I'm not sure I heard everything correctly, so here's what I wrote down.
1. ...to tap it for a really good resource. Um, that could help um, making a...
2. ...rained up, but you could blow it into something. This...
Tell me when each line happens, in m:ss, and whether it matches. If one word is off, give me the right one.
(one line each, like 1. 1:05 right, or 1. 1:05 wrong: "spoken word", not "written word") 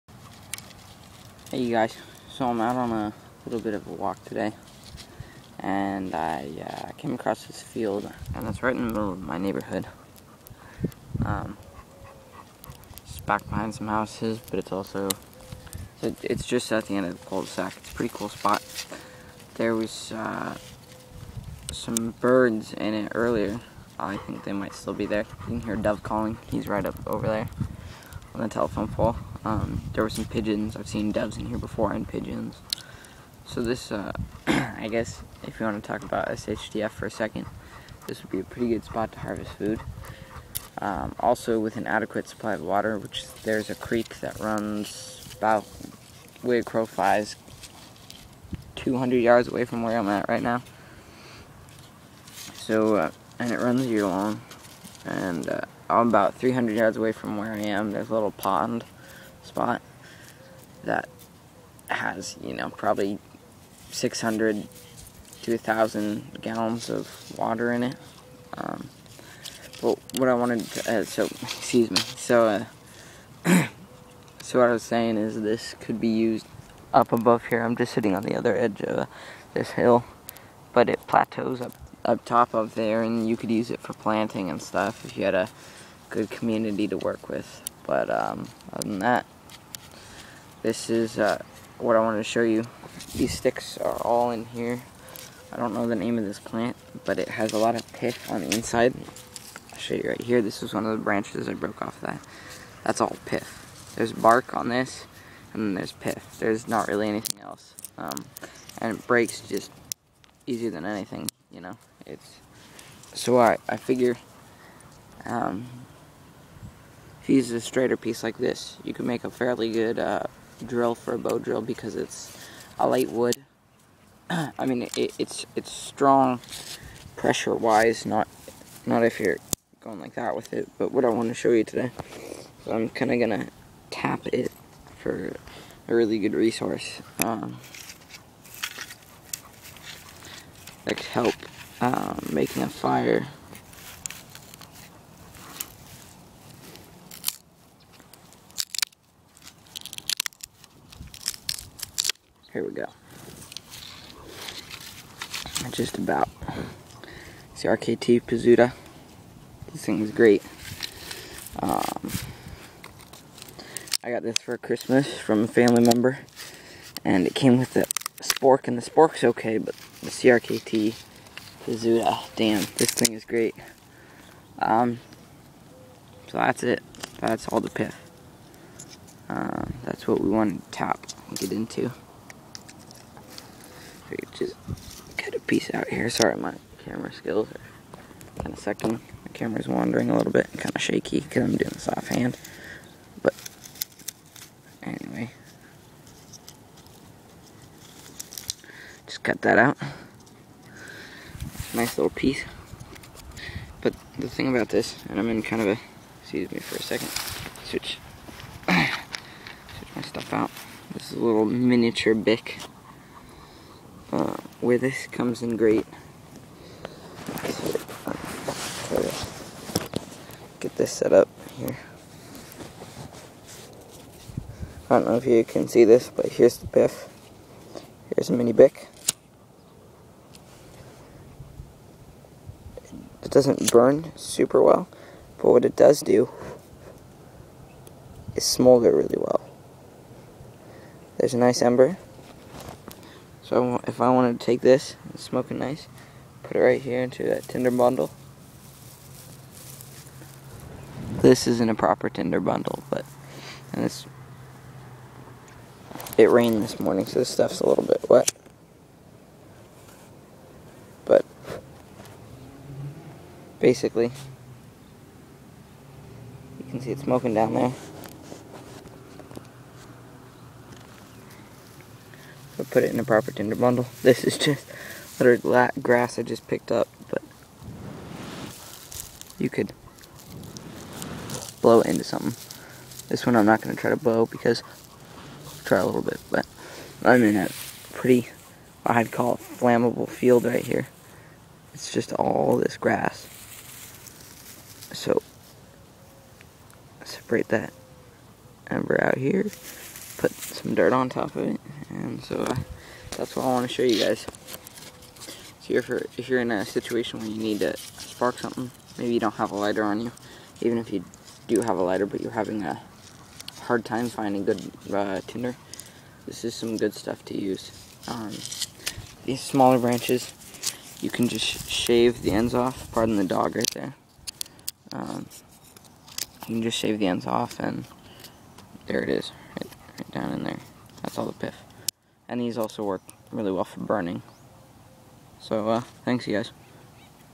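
1. 2:13 right
2. 4:36 wrong: "picked", not "rained".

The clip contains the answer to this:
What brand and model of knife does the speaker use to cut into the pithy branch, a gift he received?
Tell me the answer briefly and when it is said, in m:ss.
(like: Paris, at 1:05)
CRKT Pizzuta, at 2:50.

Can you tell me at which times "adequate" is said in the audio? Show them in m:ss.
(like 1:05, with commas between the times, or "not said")
0:41.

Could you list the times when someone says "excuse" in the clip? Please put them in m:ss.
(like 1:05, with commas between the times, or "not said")
1:11, 3:26.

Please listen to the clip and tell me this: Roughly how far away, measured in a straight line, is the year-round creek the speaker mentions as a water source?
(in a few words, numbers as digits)
200 yards.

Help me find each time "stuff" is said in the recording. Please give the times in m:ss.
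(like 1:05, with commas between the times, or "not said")
1:24, 3:30, 4:17, 5:16.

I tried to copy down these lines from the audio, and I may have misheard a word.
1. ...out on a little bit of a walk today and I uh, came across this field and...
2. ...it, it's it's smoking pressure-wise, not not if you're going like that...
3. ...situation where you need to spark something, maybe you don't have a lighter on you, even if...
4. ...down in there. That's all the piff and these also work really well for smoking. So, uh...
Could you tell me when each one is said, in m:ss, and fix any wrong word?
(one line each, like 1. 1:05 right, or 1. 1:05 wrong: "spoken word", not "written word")
1. 0:02 right
2. 2:04 wrong: "strong", not "smoking"
3. 5:06 right
4. 5:30 wrong: "burning", not "smoking".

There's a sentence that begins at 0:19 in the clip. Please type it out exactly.
There was uh, some birds in it earlier.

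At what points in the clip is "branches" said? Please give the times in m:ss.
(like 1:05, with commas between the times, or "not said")
1:41, 5:19.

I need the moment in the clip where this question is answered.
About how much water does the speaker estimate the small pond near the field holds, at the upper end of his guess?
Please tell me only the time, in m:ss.
1:05.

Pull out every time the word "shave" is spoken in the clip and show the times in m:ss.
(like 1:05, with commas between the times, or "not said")
5:21, 5:26.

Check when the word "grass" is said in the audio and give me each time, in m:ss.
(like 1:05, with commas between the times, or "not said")
4:35, 4:52.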